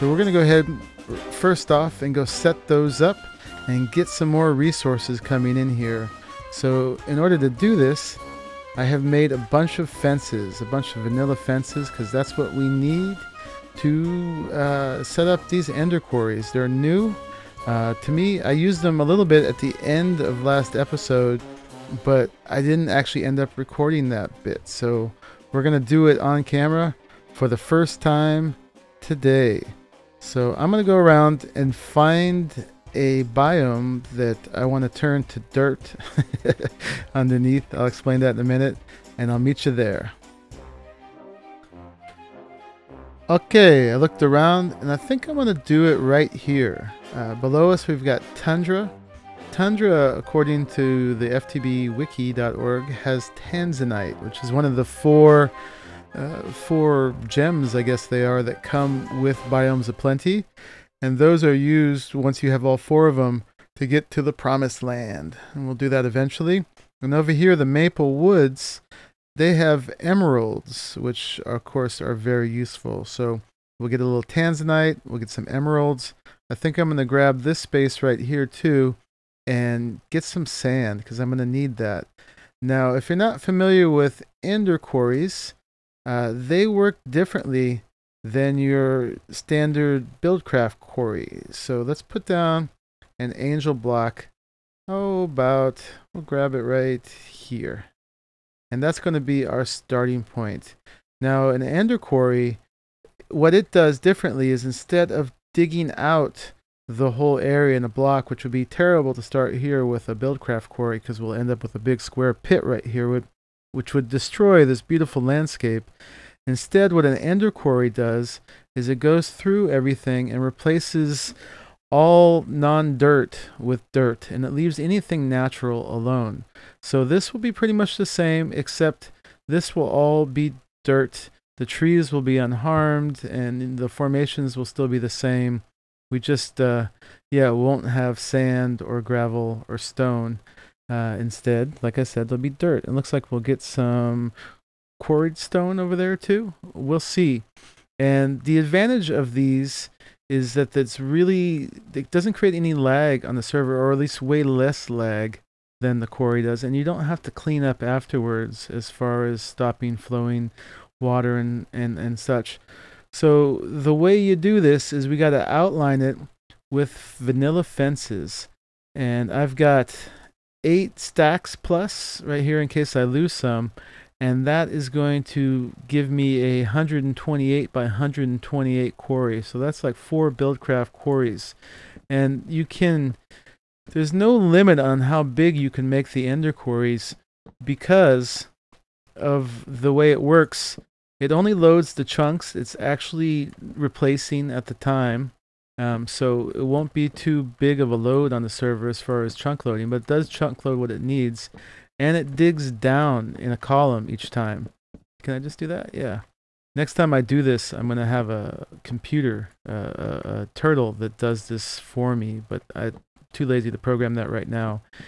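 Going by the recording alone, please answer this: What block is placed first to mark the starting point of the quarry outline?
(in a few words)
Angel block.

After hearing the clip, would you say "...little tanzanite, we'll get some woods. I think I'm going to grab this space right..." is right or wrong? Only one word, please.
wrong.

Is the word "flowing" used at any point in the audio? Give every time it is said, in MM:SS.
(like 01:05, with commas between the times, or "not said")
02:39.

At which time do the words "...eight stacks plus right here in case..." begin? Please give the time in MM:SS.
02:50.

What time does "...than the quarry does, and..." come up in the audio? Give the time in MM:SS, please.
02:35.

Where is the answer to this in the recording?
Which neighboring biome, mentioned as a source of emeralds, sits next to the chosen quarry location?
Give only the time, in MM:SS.
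01:07.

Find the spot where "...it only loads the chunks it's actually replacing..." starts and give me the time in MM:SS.
03:11.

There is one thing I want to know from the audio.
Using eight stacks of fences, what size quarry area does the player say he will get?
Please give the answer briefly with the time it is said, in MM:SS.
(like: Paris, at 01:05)
128 by 128, at 02:56.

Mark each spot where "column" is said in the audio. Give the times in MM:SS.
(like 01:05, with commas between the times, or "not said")
03:23.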